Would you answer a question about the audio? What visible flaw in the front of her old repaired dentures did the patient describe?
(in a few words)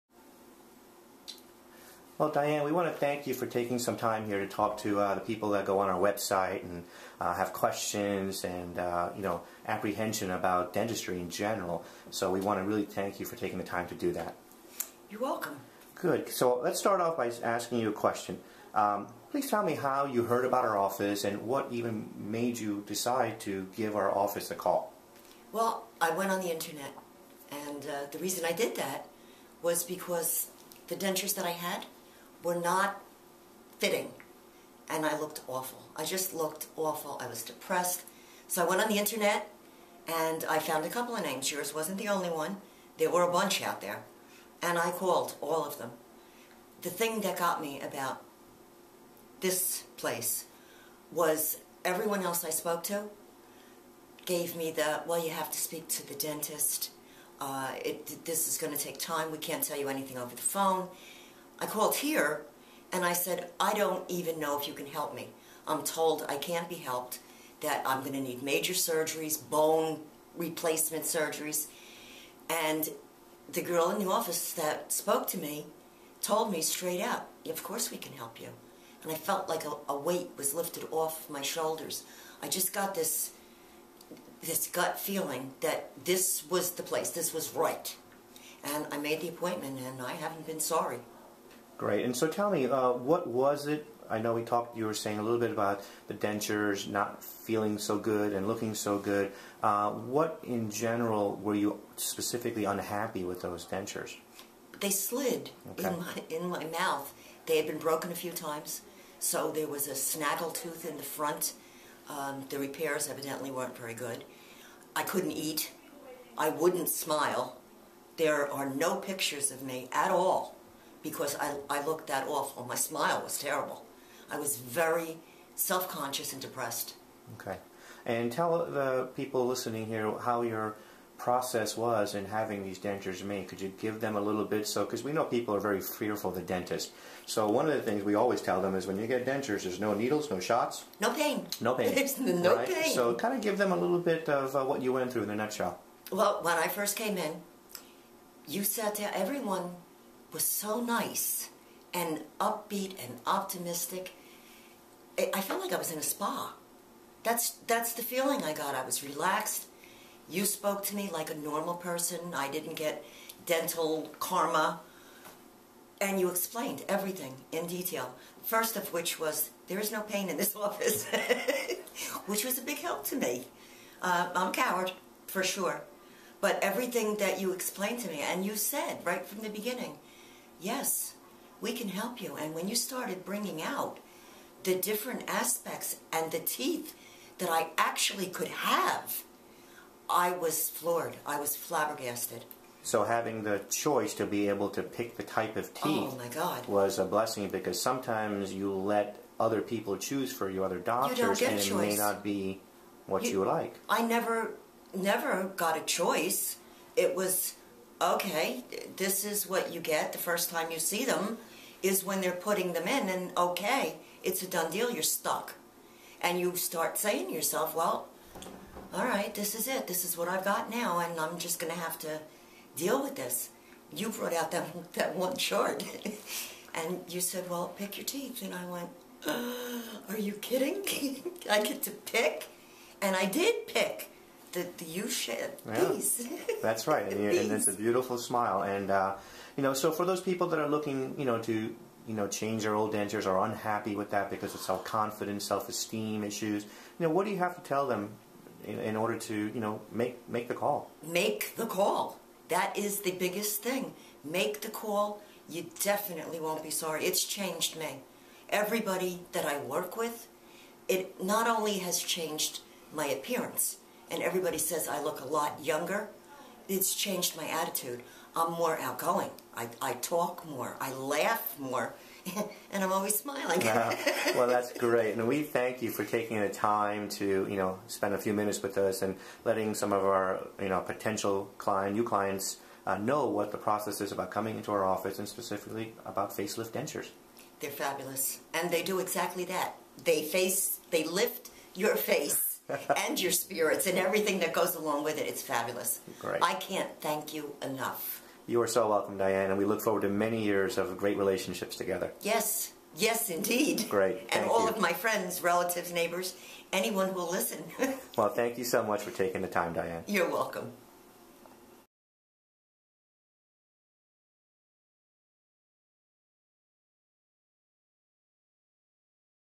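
A snaggle tooth.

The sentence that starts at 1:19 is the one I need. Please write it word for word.
And I felt like a, a weight was lifted off my shoulders.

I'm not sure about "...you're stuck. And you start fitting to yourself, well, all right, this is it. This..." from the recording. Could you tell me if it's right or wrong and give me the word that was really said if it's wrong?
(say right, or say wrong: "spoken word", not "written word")
wrong: "saying", not "fitting".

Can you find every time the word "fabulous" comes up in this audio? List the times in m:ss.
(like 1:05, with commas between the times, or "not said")
4:47, 4:55.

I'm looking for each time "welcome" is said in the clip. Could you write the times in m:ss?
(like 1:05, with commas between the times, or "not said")
0:15, 4:58, 5:10.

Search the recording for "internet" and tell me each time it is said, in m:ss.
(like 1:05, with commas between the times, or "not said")
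0:26, 0:38.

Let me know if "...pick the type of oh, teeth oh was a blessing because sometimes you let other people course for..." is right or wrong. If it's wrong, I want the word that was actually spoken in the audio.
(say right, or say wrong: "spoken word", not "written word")
wrong: "choose", not "course".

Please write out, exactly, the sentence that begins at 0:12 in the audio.
So we want to really thank you for taking the time to do that.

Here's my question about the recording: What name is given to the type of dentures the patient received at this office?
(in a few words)
Facelift dentures.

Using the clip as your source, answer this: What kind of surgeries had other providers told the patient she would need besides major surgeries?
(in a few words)
Bone replacement surgeries.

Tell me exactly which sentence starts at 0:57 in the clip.
Uh, it, this is going to take time.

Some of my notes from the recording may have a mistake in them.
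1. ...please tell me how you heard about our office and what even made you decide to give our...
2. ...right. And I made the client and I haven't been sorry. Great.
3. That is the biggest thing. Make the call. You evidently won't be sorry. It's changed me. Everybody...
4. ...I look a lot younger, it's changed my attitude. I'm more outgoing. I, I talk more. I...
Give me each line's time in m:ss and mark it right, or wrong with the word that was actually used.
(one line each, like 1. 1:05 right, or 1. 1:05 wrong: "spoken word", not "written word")
1. 0:19 right
2. 1:27 wrong: "appointment", not "client"
3. 4:12 wrong: "definitely", not "evidently"
4. 4:24 right.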